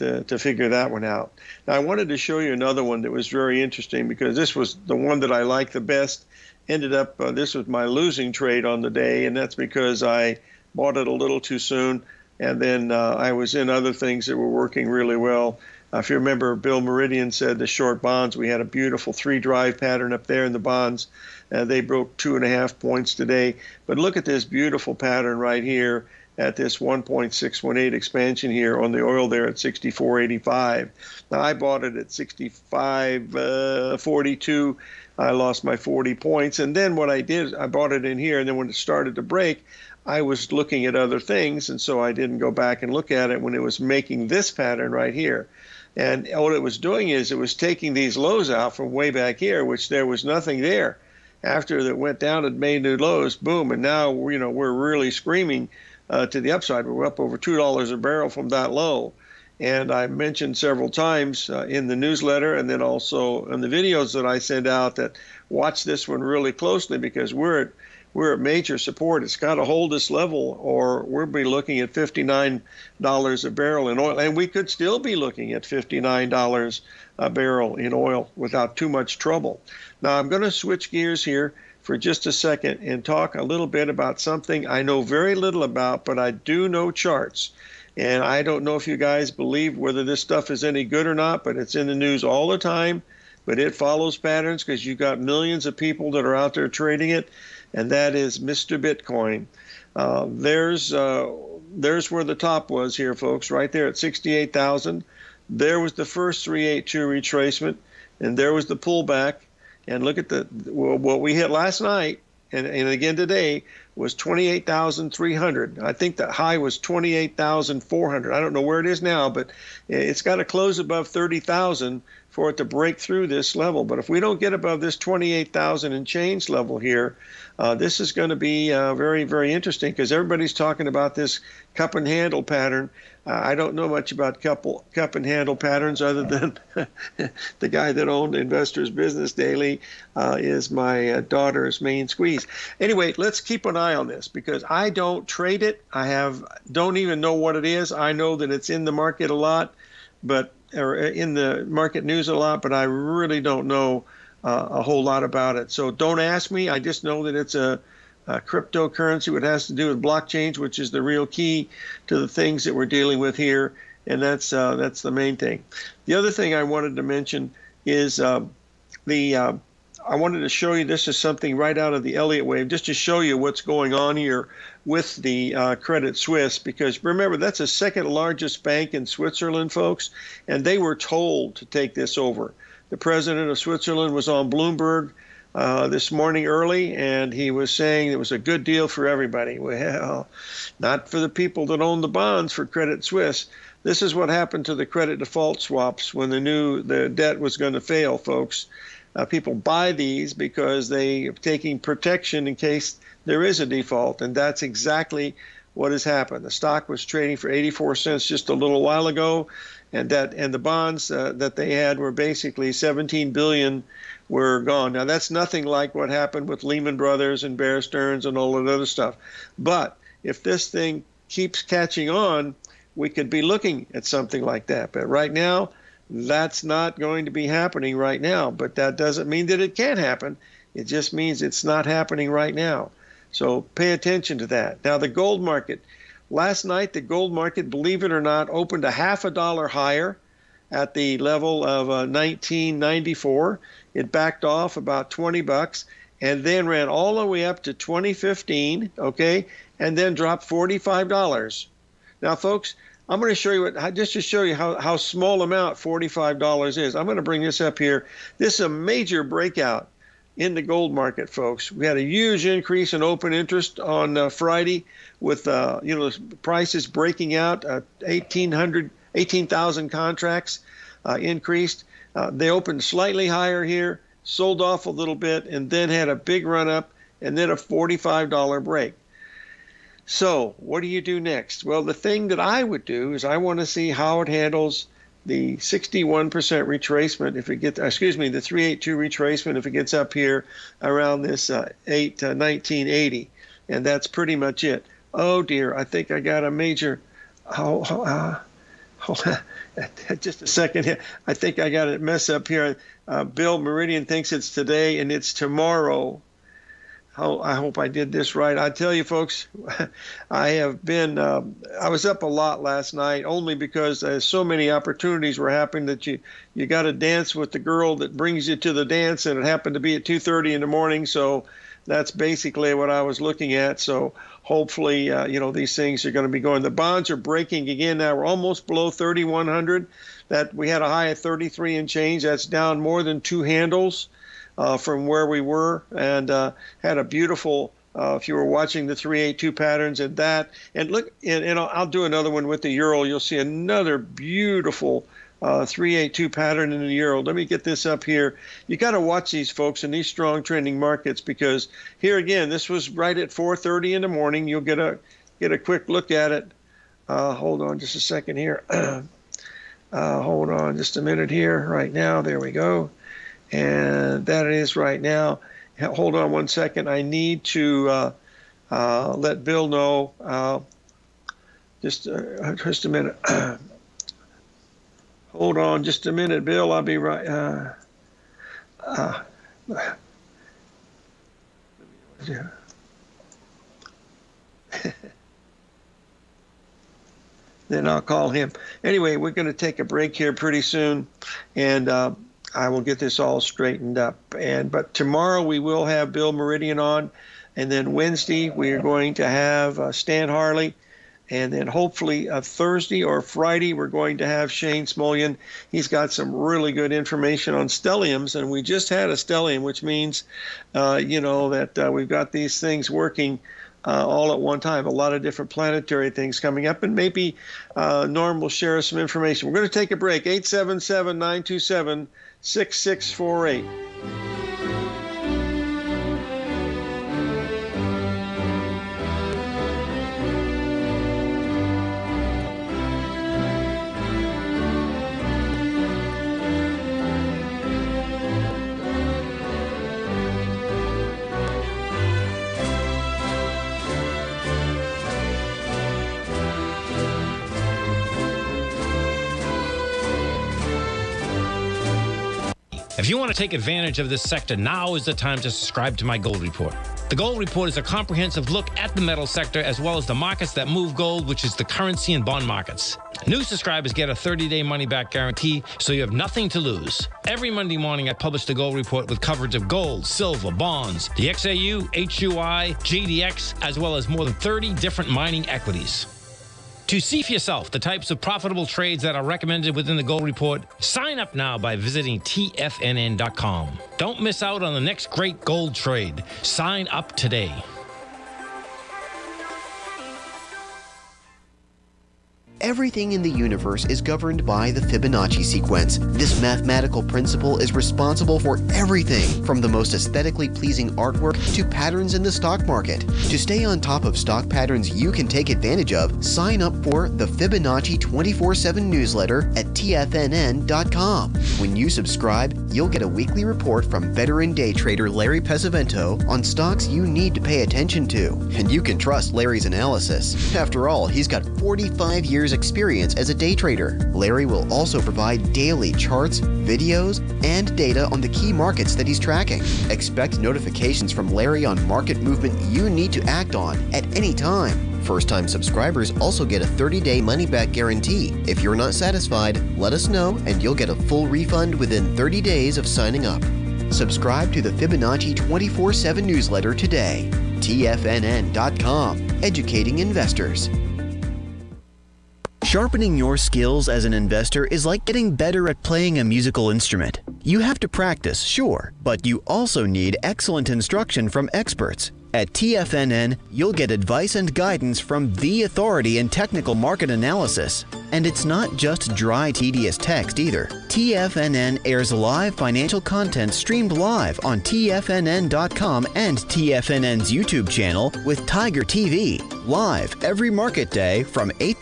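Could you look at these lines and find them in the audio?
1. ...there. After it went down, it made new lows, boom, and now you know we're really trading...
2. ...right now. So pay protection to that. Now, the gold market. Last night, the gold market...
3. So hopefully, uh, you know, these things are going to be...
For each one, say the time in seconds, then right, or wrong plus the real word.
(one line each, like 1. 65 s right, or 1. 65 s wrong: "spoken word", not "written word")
1. 50 s wrong: "screaming", not "trading"
2. 232 s wrong: "attention", not "protection"
3. 323 s right.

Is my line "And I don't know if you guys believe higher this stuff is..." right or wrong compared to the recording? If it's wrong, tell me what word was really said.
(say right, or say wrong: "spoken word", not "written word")
wrong: "whether", not "higher".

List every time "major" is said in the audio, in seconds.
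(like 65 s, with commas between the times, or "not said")
68 s, 258 s, 296 s.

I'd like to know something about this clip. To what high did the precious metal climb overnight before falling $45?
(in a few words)
2015.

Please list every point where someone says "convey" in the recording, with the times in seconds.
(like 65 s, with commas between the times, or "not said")
not said.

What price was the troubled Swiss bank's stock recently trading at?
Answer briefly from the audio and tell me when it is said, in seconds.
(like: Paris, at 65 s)
84 cents, at 207 s.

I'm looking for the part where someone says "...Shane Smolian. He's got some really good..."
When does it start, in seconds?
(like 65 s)
404 s.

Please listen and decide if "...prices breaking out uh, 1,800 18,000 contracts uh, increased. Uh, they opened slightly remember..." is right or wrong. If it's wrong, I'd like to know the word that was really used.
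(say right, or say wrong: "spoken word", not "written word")
wrong: "higher", not "remember".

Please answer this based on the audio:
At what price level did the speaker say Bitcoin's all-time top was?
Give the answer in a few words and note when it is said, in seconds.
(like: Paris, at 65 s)
68,000, at 103 s.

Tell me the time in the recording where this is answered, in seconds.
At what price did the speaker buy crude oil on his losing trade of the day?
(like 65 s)
32 s.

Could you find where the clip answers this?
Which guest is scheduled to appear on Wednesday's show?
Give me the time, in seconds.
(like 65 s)
399 s.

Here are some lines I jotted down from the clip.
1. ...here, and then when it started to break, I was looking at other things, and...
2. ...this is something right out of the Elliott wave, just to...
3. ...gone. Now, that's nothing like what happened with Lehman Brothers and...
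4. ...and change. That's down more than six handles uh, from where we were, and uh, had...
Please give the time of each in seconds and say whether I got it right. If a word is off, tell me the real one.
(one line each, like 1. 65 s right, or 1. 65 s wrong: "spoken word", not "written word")
1. 38 s right
2. 170 s right
3. 214 s right
4. 331 s wrong: "two", not "six".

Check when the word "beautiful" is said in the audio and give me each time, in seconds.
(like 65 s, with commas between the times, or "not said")
18 s, 24 s, 337 s, 343 s.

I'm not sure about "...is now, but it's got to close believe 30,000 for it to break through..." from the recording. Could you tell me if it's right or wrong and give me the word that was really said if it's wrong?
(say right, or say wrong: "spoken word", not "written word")
wrong: "above", not "believe".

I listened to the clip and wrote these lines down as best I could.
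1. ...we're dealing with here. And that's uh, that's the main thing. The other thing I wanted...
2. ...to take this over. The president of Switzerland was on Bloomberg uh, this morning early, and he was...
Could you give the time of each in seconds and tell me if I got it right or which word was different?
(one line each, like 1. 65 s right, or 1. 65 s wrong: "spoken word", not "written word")
1. 162 s right
2. 181 s right.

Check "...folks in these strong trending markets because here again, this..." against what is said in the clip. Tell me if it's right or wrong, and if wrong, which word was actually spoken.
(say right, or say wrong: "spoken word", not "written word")
right.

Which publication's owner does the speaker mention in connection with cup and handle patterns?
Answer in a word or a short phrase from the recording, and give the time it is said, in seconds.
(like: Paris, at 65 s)
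Investors Business Daily, at 138 s.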